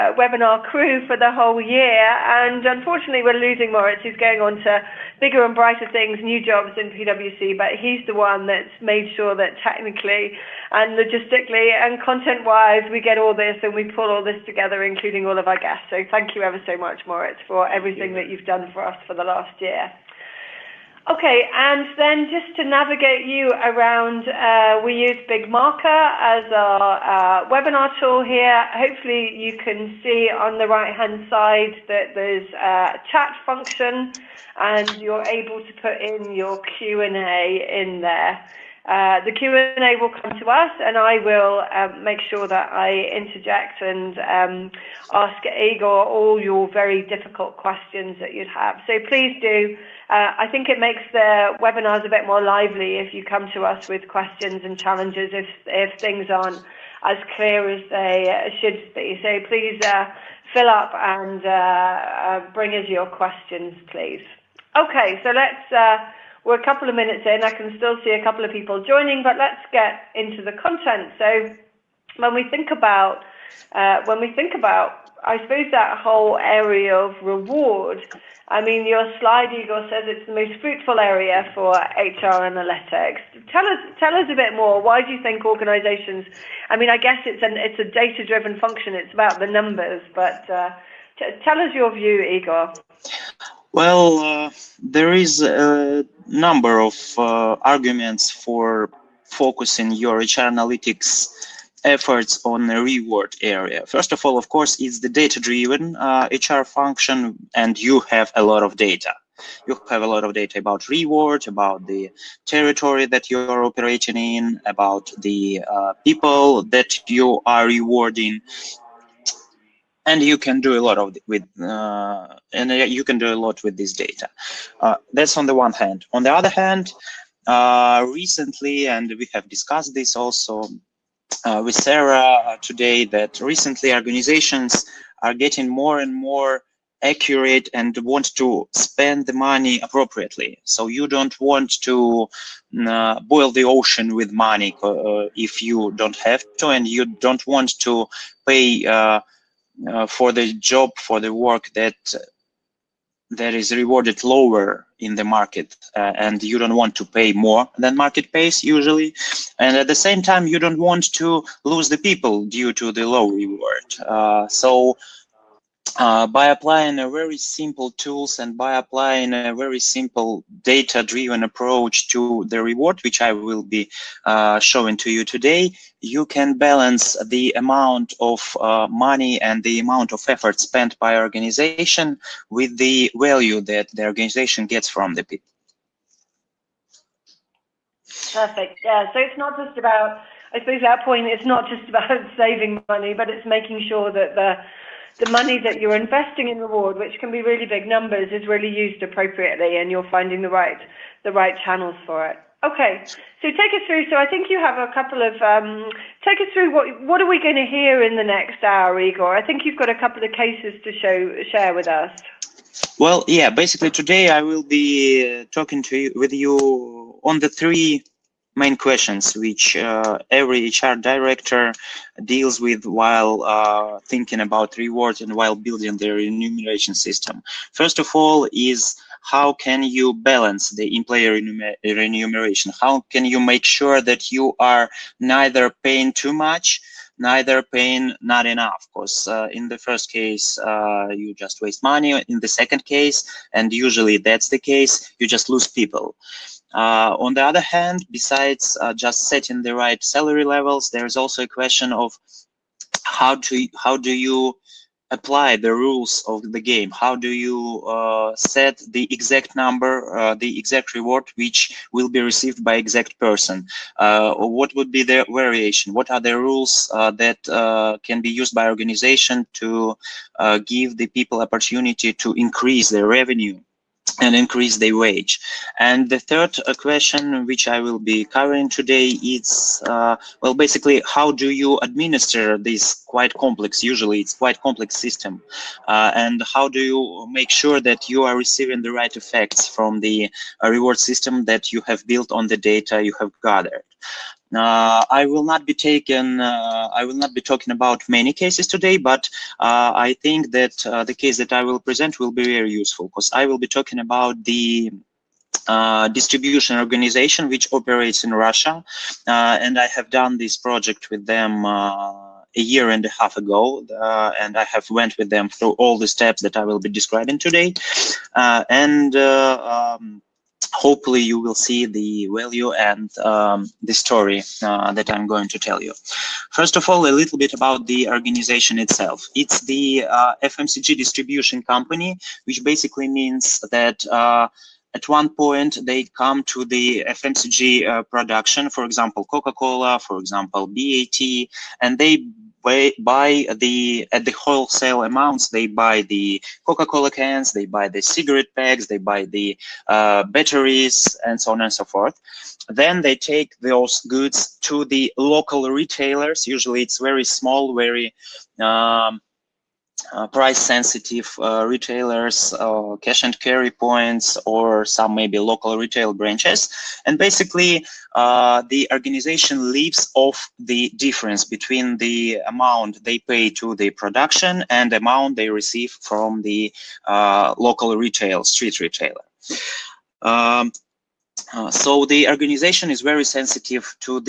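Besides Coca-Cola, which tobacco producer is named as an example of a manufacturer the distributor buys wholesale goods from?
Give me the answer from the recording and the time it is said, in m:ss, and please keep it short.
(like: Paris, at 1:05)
BAT, at 5:40.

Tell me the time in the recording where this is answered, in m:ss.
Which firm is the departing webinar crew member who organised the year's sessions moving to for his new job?
0:06.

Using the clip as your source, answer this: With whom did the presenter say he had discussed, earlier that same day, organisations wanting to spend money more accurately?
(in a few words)
Sarah.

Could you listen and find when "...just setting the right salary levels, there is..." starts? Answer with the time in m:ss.
4:08.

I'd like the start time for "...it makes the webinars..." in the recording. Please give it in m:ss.
0:50.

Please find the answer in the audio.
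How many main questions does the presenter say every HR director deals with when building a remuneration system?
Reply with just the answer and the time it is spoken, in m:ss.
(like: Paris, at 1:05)
3, at 3:37.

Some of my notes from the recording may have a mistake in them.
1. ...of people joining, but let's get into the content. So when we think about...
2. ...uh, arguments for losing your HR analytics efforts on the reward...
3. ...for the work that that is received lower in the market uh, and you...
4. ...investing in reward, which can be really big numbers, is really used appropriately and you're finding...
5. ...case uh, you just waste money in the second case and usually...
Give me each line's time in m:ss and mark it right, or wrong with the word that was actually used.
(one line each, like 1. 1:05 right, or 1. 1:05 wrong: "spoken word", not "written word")
1. 1:08 right
2. 1:37 wrong: "focusing", not "losing"
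3. 2:30 wrong: "rewarded", not "received"
4. 3:15 right
5. 4:00 right.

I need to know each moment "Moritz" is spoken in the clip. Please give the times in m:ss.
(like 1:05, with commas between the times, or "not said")
0:03, 0:17.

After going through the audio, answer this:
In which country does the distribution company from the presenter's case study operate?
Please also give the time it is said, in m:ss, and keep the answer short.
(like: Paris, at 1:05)
Russia, at 5:08.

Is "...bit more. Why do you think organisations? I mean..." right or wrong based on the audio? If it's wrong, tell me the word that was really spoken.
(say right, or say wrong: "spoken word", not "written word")
right.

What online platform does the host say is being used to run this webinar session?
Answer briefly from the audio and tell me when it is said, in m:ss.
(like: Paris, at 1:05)
BigMarker, at 0:25.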